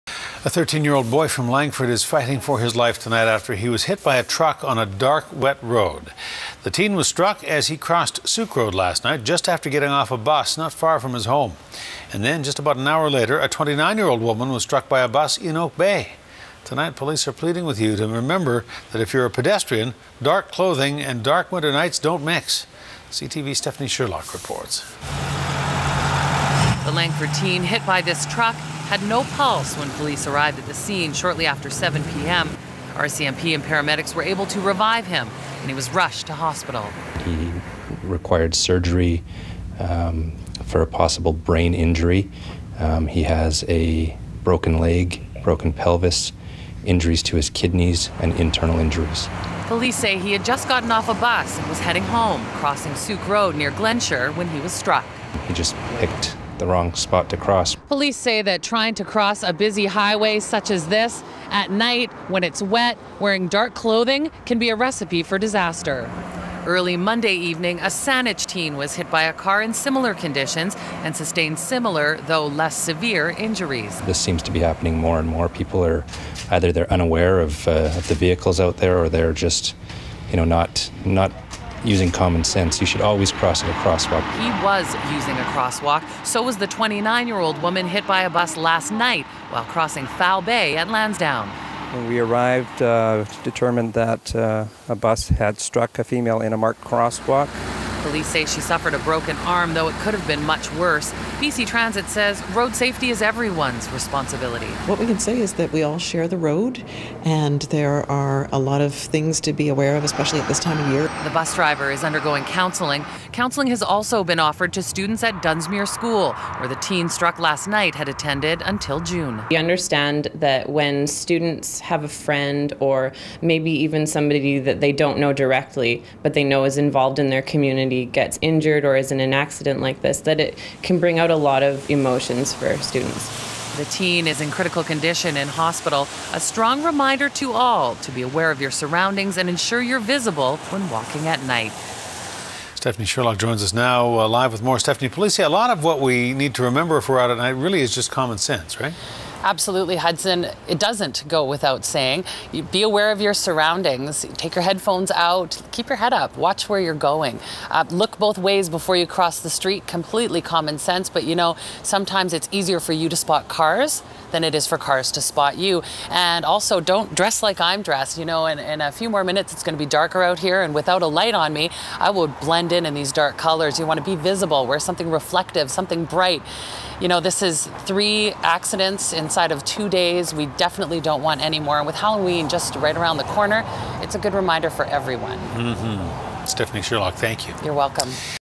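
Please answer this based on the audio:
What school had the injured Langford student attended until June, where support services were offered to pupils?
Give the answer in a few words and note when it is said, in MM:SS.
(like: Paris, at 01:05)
Dunsmuir School, at 01:55.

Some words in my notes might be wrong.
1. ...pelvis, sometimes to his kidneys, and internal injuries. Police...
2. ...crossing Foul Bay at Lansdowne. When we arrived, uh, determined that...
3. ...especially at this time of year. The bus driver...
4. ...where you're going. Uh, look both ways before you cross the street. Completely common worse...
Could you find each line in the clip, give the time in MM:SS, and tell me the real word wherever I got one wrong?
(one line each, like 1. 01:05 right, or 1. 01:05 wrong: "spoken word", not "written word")
1. 00:45 wrong: "injuries", not "sometimes"
2. 01:29 right
3. 01:50 right
4. 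02:36 wrong: "sense", not "worse".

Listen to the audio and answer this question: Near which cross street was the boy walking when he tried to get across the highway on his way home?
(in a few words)
Glenshire.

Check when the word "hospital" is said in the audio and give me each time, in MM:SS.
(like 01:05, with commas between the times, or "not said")
00:36, 02:15.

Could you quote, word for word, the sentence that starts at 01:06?
Early Monday evening, a Saanich teen was hit by a car in similar conditions and sustained similar, though less severe, injuries.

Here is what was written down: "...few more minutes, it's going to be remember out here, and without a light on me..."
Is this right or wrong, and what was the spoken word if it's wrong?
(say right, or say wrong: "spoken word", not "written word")
wrong: "darker", not "remember".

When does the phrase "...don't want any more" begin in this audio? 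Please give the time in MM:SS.
03:00.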